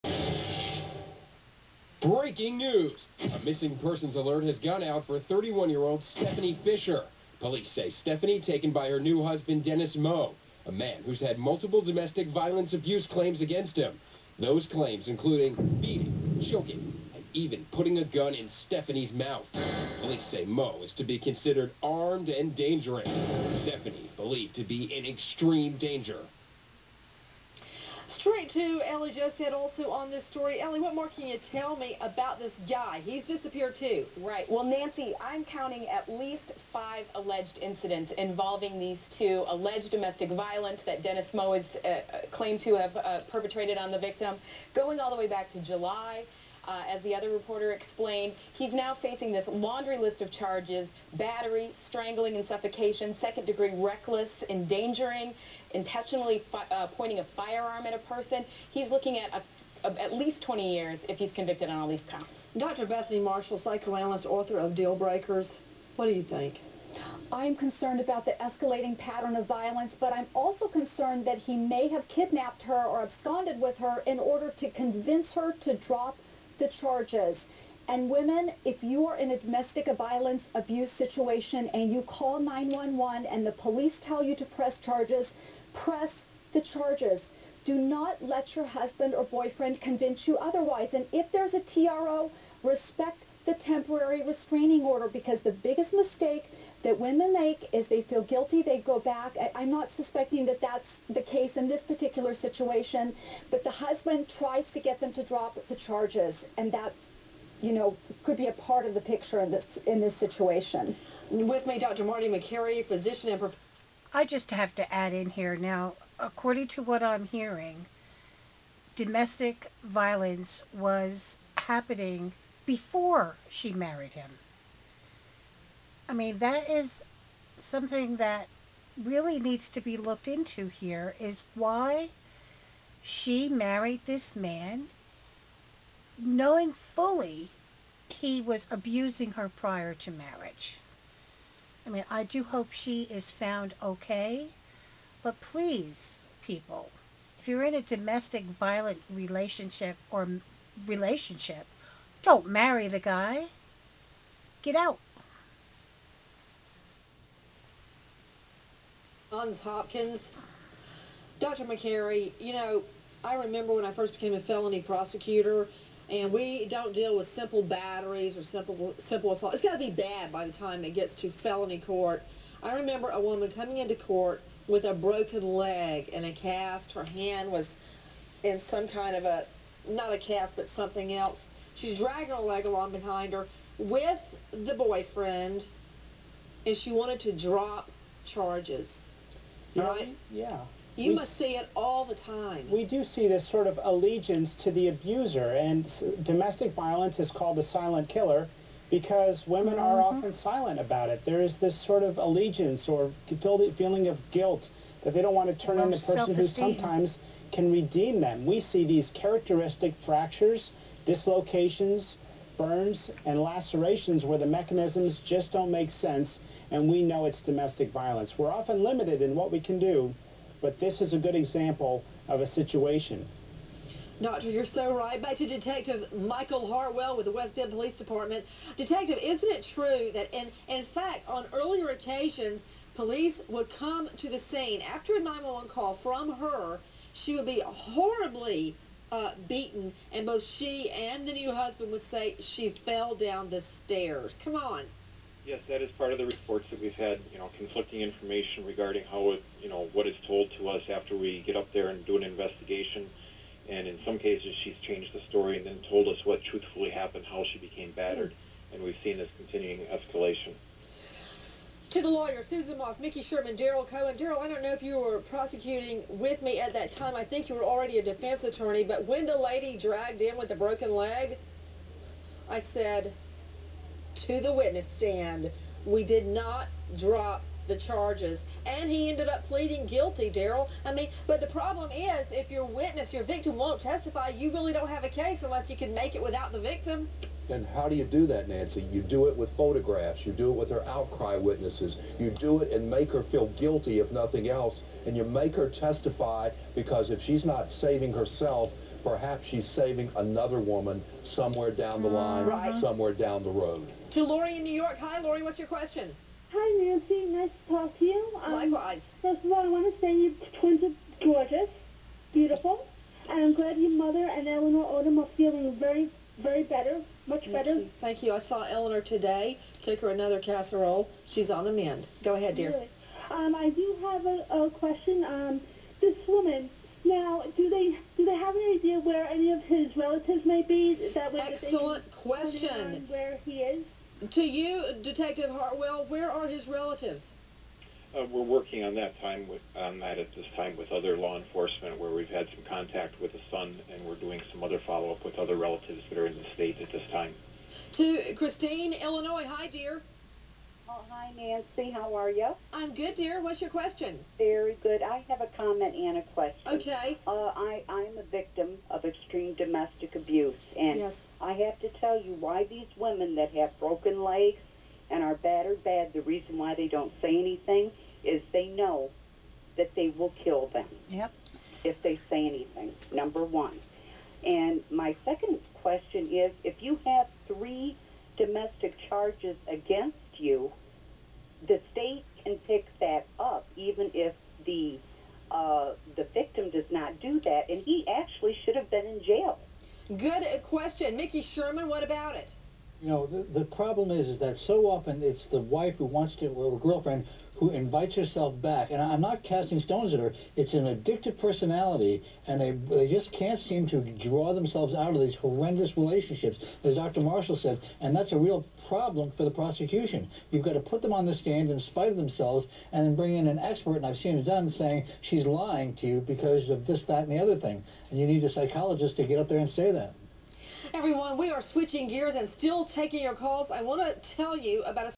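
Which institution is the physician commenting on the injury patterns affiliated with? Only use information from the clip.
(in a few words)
Johns Hopkins.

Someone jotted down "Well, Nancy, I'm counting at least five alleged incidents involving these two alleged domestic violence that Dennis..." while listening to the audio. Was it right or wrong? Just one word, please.
right.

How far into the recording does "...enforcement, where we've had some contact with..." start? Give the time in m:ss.
5:41.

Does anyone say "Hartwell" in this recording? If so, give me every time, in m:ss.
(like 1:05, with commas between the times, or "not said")
3:46, 5:35.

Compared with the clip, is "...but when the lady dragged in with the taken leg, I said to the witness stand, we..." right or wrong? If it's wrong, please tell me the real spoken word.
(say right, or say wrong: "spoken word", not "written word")
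wrong: "broken", not "taken".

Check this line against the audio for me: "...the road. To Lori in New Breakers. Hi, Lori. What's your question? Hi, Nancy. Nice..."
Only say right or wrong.
wrong.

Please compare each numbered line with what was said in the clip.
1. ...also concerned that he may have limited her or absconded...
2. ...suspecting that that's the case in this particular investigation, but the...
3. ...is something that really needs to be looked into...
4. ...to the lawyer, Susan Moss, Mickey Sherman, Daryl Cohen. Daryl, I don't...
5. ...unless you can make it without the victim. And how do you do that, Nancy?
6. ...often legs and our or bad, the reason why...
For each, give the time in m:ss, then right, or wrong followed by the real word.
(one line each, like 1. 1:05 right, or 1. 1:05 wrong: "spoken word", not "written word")
1. 1:10 wrong: "kidnapped", not "limited"
2. 1:39 wrong: "situation", not "investigation"
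3. 2:06 right
4. 4:21 right
5. 4:45 right
6. 6:03 wrong: "broken", not "often".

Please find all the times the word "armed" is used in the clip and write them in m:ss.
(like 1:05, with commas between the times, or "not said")
0:21.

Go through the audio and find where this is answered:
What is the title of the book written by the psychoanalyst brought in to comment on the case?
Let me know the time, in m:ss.
1:04.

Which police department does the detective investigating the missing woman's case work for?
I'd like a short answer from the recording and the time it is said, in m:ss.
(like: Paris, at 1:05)
West Bend Police Department, at 3:47.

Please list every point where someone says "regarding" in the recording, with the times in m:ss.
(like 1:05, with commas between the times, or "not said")
4:08.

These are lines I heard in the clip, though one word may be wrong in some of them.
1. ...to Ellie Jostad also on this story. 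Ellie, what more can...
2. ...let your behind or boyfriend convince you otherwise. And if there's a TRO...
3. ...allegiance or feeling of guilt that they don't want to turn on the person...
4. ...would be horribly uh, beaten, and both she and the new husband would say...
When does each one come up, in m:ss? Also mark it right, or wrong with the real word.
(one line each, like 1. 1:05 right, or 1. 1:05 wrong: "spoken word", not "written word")
1. 0:28 right
2. 1:28 wrong: "husband", not "behind"
3. 3:22 right
4. 3:57 right.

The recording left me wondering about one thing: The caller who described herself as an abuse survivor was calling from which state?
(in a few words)
Illinois.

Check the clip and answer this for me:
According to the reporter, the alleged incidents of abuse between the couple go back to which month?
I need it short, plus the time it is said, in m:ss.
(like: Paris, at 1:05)
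July, at 0:45.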